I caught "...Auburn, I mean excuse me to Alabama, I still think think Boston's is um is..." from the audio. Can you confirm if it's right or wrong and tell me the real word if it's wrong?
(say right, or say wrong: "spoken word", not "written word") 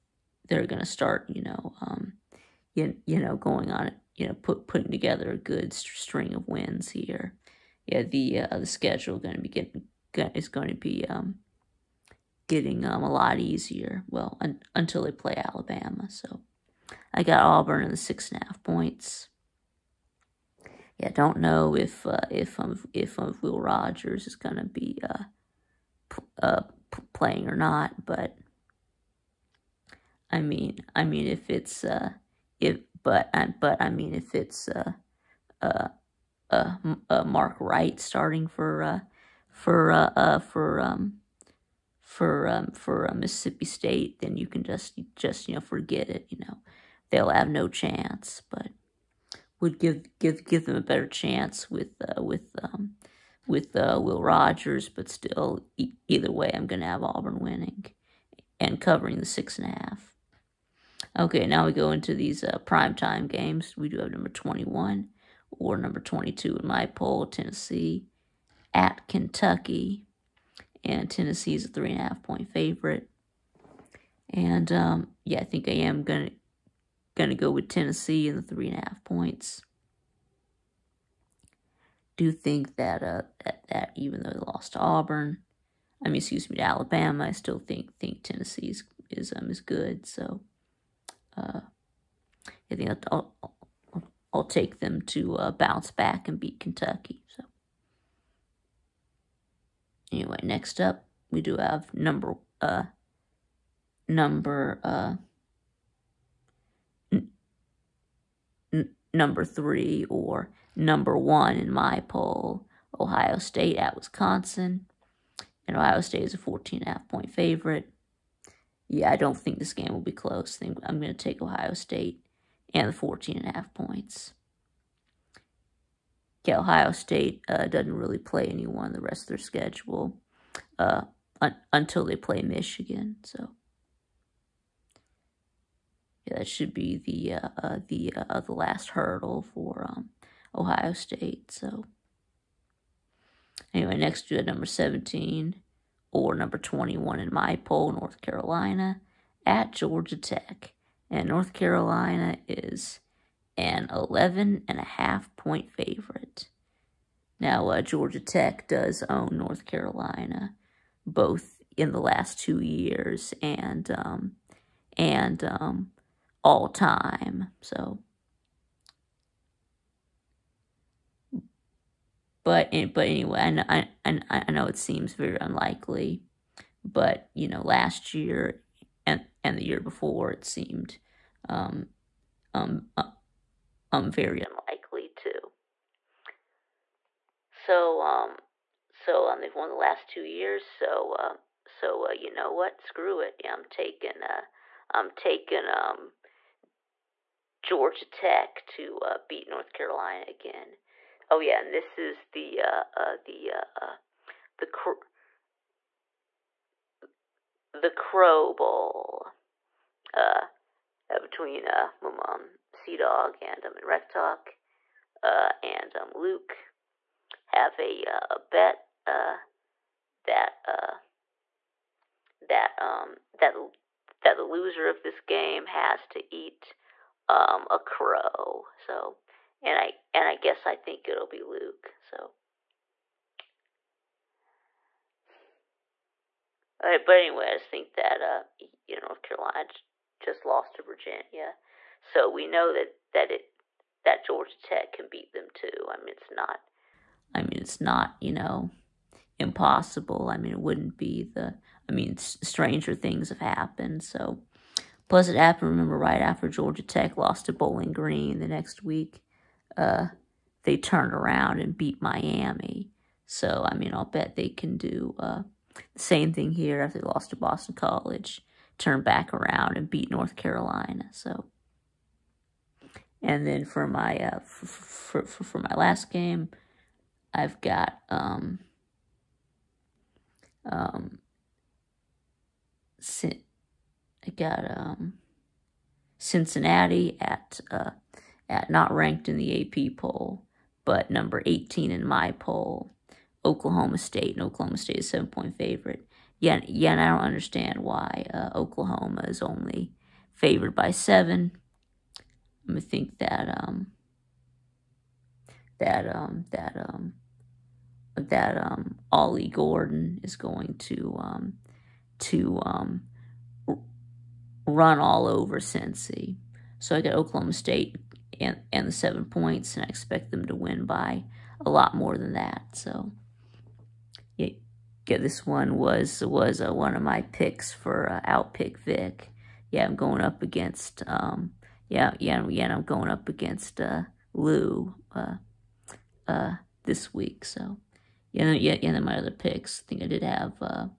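wrong: "Tennessee", not "Boston".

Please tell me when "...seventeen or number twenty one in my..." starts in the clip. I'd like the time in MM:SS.
02:24.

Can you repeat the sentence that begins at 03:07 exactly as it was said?
So, um, so um, they've won the last two years.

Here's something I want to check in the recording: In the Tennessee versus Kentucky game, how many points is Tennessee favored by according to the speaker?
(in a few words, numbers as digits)
3.5.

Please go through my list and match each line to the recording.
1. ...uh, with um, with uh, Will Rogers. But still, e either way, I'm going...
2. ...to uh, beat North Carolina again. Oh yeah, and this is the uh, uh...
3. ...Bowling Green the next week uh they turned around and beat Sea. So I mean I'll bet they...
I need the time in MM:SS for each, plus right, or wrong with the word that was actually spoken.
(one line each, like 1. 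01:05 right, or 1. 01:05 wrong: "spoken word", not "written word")
1. 00:52 right
2. 03:18 right
3. 04:17 wrong: "Miami", not "Sea".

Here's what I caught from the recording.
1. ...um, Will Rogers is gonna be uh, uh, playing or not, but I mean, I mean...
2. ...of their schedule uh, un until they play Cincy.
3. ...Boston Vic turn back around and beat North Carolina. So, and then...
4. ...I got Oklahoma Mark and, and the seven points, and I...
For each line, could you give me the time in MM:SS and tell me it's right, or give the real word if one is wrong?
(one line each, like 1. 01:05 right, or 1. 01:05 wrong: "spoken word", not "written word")
1. 00:23 right
2. 02:09 wrong: "Michigan", not "Cincy"
3. 04:27 wrong: "College", not "Vic"
4. 05:16 wrong: "State", not "Mark".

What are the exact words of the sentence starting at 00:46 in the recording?
You know, they'll have no chance.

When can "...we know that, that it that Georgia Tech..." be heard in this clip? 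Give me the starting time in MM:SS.
04:02.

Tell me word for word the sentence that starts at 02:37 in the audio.
Now, uh, Georgia Tech does own North Carolina, both in the last two years and um, and um, all time.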